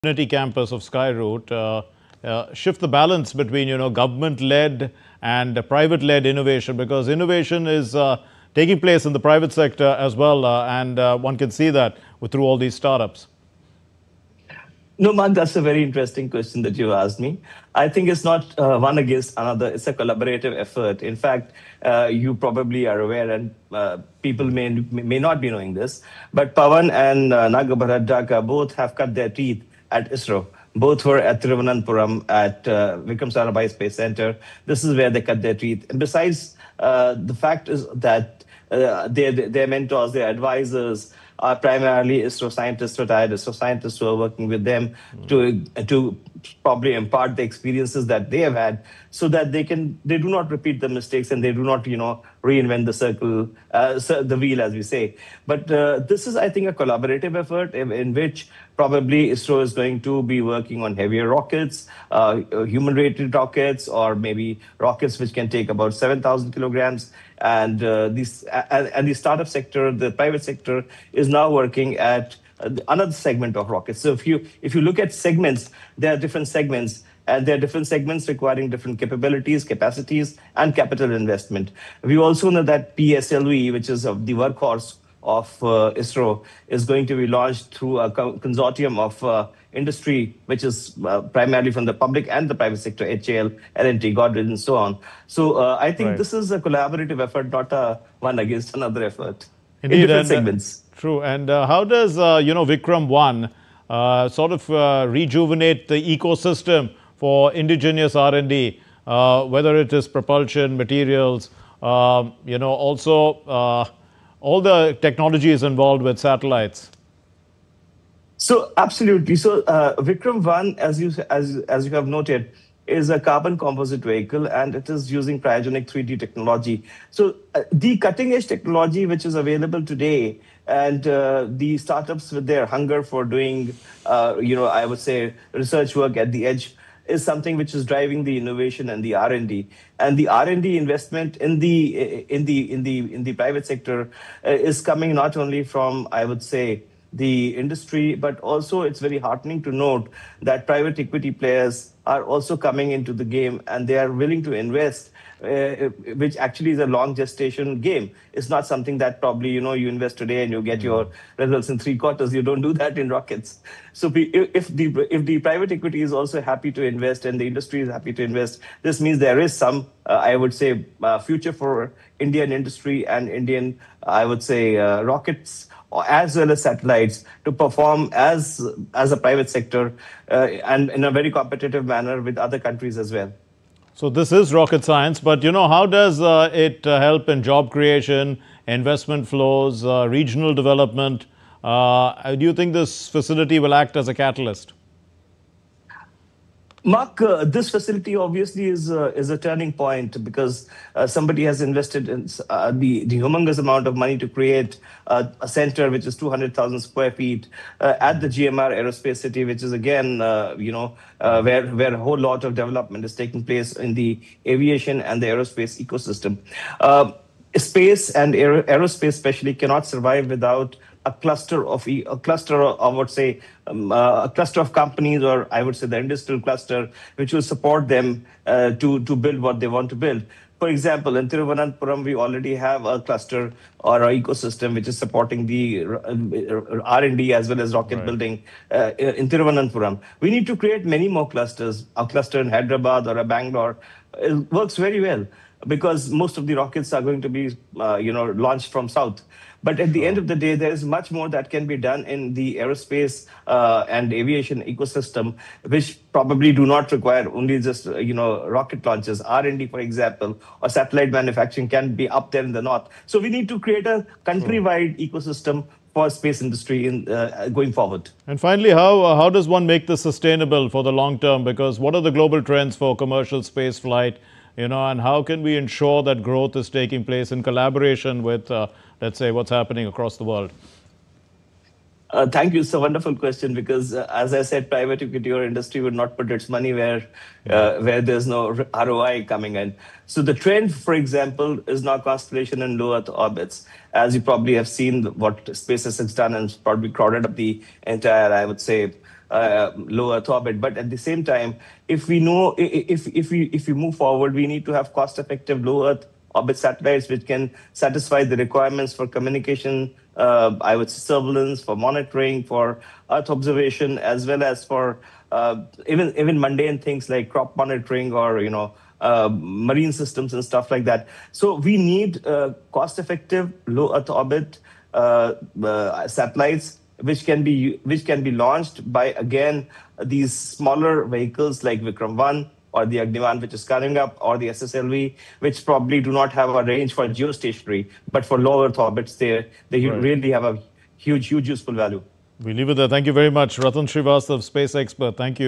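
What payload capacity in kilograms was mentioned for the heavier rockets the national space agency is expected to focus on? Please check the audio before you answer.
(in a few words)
7000.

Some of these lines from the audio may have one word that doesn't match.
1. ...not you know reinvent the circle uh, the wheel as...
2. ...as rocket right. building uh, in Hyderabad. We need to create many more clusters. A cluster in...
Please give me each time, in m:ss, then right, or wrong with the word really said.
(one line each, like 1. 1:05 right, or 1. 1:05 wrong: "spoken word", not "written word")
1. 0:51 right
2. 3:57 wrong: "Thiruvananthapuram", not "Hyderabad".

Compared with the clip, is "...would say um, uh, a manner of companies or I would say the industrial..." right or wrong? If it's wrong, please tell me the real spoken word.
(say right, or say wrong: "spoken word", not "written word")
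wrong: "cluster", not "manner".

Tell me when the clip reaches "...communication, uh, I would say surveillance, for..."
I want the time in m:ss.
5:09.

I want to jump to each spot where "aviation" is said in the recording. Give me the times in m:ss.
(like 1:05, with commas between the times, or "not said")
3:34, 4:14.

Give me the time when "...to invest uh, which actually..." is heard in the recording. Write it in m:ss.
2:34.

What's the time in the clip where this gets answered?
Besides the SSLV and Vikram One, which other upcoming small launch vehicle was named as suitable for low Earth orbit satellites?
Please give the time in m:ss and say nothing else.
5:33.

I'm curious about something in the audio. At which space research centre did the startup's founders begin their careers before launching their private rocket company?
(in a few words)
Vikram Sarabhai Space Center.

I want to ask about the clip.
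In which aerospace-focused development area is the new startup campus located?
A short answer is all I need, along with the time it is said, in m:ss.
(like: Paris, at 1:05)
GMR Aerospace City, at 3:28.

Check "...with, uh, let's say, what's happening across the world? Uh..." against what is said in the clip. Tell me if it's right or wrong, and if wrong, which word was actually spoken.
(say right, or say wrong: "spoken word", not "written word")
right.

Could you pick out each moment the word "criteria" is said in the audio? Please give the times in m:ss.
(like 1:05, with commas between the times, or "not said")
not said.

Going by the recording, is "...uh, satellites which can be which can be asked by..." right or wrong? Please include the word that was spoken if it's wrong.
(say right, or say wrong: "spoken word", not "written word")
wrong: "launched", not "asked".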